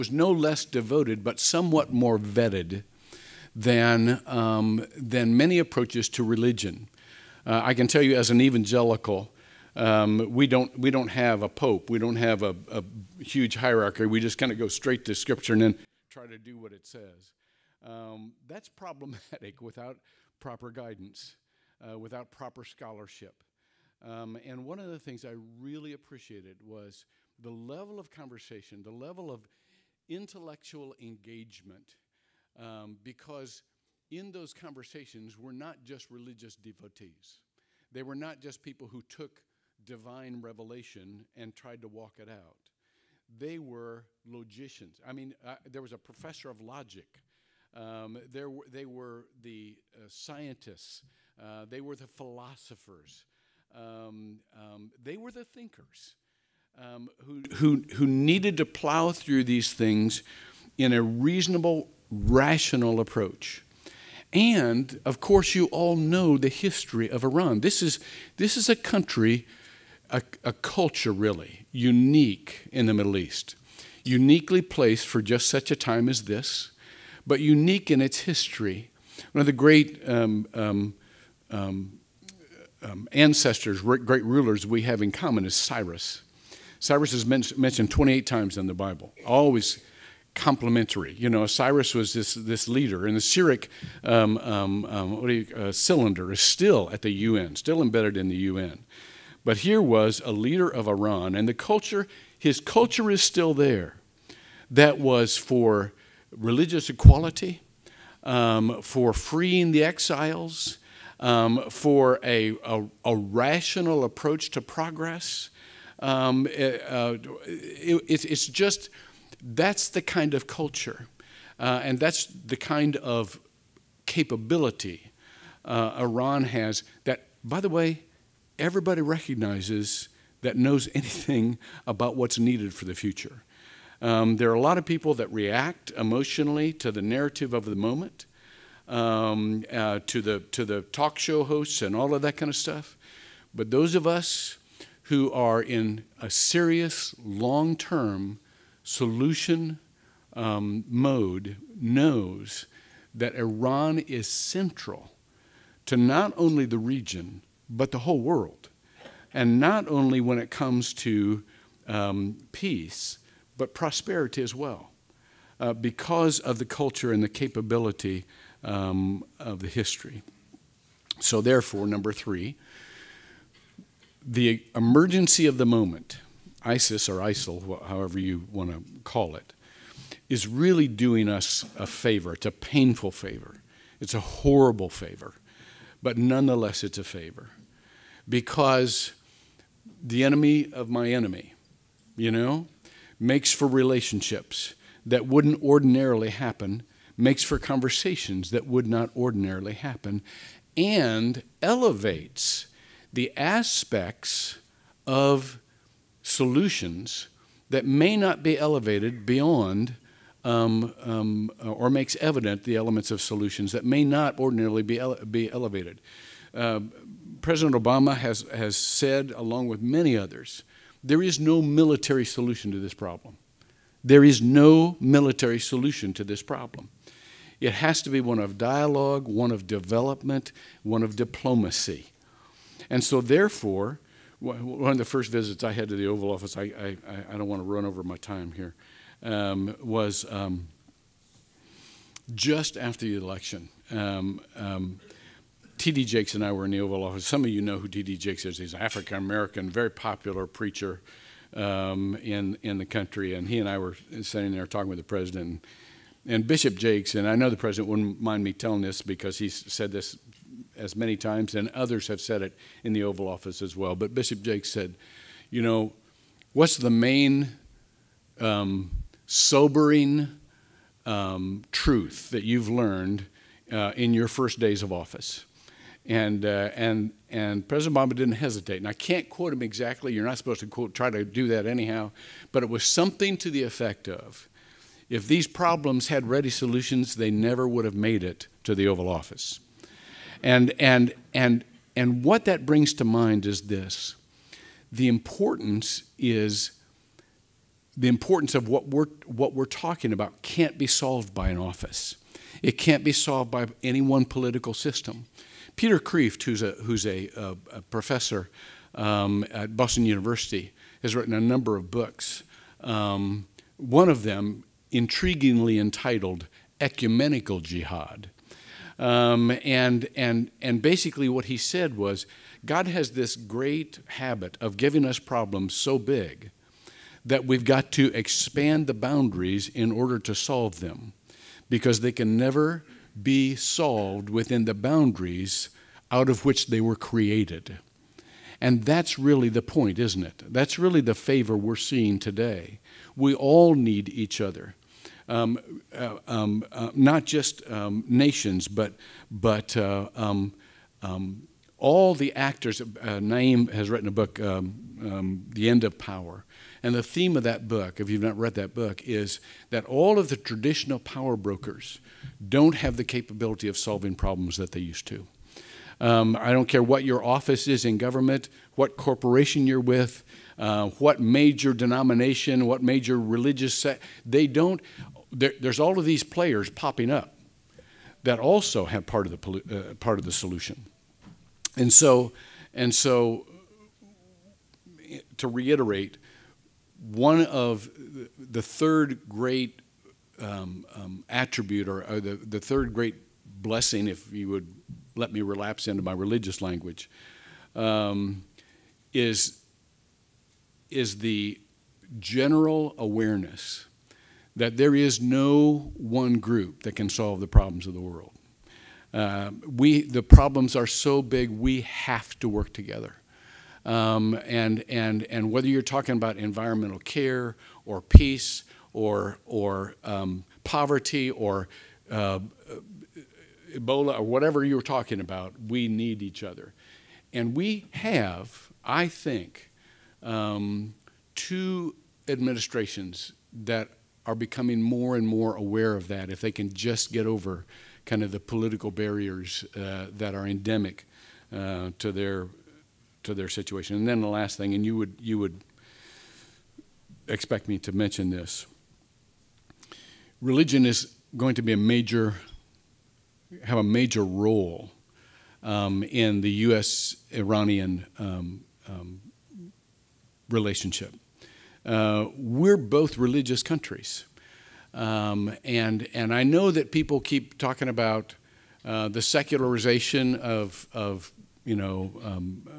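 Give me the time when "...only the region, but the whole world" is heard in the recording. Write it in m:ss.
2:36.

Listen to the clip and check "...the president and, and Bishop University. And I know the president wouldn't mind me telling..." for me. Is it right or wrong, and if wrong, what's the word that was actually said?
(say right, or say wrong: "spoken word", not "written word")
wrong: "Jakes", not "University".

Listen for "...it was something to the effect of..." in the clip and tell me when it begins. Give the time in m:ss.
4:42.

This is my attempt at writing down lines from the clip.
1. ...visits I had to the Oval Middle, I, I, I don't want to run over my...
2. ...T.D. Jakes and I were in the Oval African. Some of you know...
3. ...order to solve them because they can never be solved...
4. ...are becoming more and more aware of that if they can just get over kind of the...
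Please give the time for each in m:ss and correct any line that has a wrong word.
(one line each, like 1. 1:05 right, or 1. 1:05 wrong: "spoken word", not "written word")
1. 3:55 wrong: "Office", not "Middle"
2. 4:05 wrong: "Office", not "African"
3. 5:29 right
4. 7:14 right.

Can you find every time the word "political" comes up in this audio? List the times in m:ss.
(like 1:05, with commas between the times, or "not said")
5:04, 7:18.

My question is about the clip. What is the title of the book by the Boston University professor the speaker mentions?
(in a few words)
Ecumenical Jihad.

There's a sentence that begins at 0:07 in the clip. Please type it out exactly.
Uh, I can tell you as an evangelical, um, we don't we don't have a pope.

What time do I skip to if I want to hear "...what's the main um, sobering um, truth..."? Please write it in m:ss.
4:26.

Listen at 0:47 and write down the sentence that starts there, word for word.
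Um, there were, they were the uh, scientists.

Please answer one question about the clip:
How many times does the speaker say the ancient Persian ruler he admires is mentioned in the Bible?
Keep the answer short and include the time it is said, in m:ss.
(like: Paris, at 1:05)
28, at 1:27.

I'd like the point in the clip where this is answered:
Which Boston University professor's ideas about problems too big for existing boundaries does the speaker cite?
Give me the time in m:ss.
5:05.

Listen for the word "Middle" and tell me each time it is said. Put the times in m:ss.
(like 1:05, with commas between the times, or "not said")
1:12.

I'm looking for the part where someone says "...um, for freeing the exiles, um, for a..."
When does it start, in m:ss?
1:48.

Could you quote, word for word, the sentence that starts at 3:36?
Uh, President Obama has, has said, along with many others, there is no military solution to this problem.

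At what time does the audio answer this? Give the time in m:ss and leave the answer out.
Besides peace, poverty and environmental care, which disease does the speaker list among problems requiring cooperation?
7:03.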